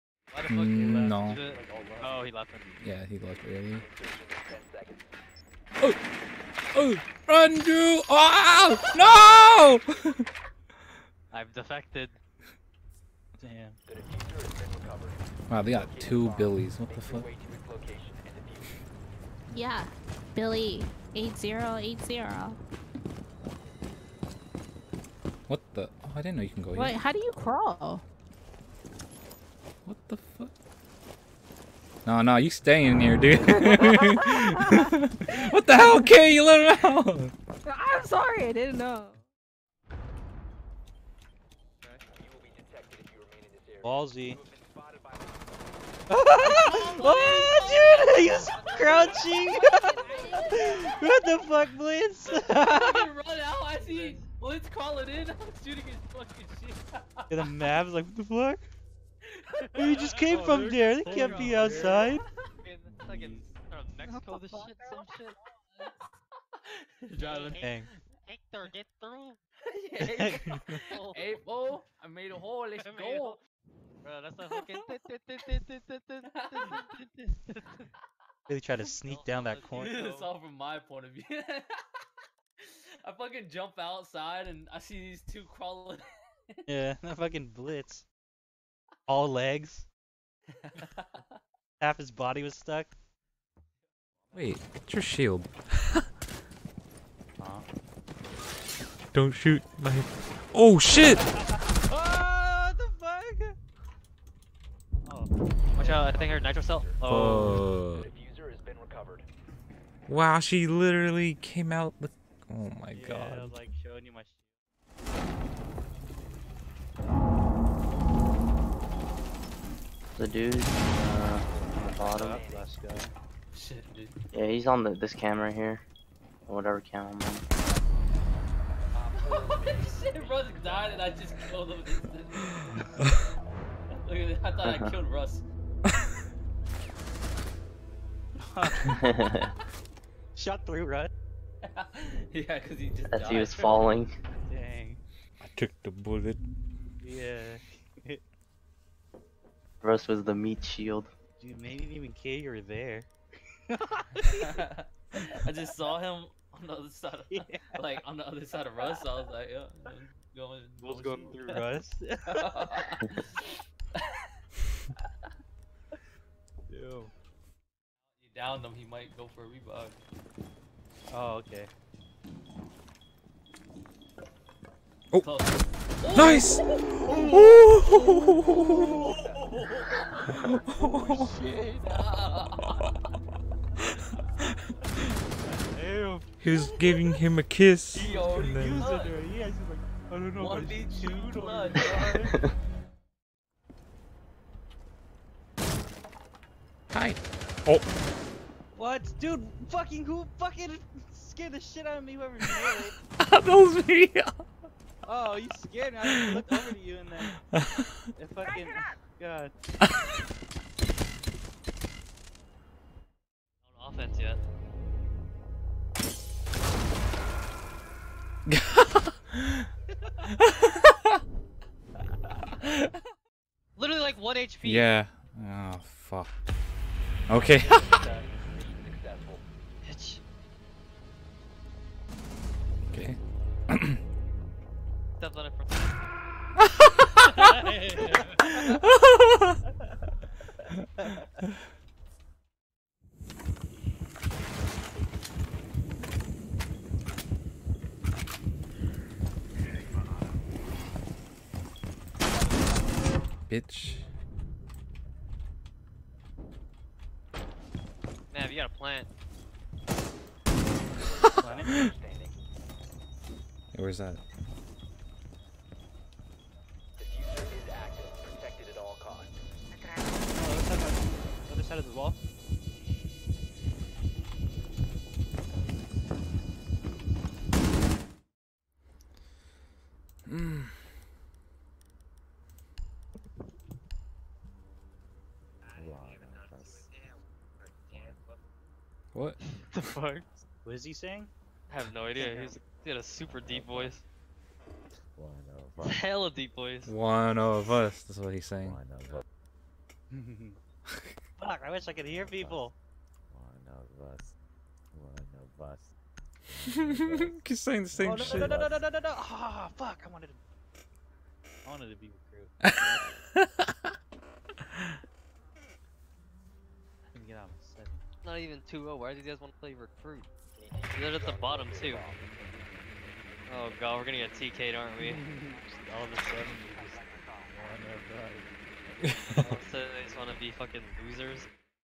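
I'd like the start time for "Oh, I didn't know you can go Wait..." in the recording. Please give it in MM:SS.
00:26.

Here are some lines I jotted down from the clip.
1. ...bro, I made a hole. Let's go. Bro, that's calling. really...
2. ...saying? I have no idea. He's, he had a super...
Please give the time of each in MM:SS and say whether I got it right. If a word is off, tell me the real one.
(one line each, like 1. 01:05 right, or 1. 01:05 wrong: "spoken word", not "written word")
1. 01:11 wrong: "fucking", not "calling"
2. 04:50 right.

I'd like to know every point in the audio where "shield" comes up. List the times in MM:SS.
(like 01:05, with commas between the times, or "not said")
01:35, 02:30.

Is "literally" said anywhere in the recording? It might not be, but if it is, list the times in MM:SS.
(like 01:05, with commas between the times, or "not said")
01:50, 03:43.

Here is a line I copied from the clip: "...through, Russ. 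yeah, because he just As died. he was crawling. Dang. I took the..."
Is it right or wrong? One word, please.
wrong.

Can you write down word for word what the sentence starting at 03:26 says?
I looked over to you and then.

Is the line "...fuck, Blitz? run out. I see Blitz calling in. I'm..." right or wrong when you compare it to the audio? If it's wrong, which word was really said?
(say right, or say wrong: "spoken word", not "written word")
right.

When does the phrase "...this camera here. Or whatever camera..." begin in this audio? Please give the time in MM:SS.
02:04.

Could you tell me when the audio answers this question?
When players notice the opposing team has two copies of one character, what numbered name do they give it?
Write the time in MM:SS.
00:20.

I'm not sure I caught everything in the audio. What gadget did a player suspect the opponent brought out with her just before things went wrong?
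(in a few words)
nitro cell.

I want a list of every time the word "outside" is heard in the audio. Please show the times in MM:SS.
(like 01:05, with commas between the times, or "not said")
01:01, 01:23.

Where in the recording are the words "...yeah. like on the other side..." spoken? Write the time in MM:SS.
02:37.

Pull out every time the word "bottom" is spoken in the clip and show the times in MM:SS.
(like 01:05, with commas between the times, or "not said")
02:01, 05:21.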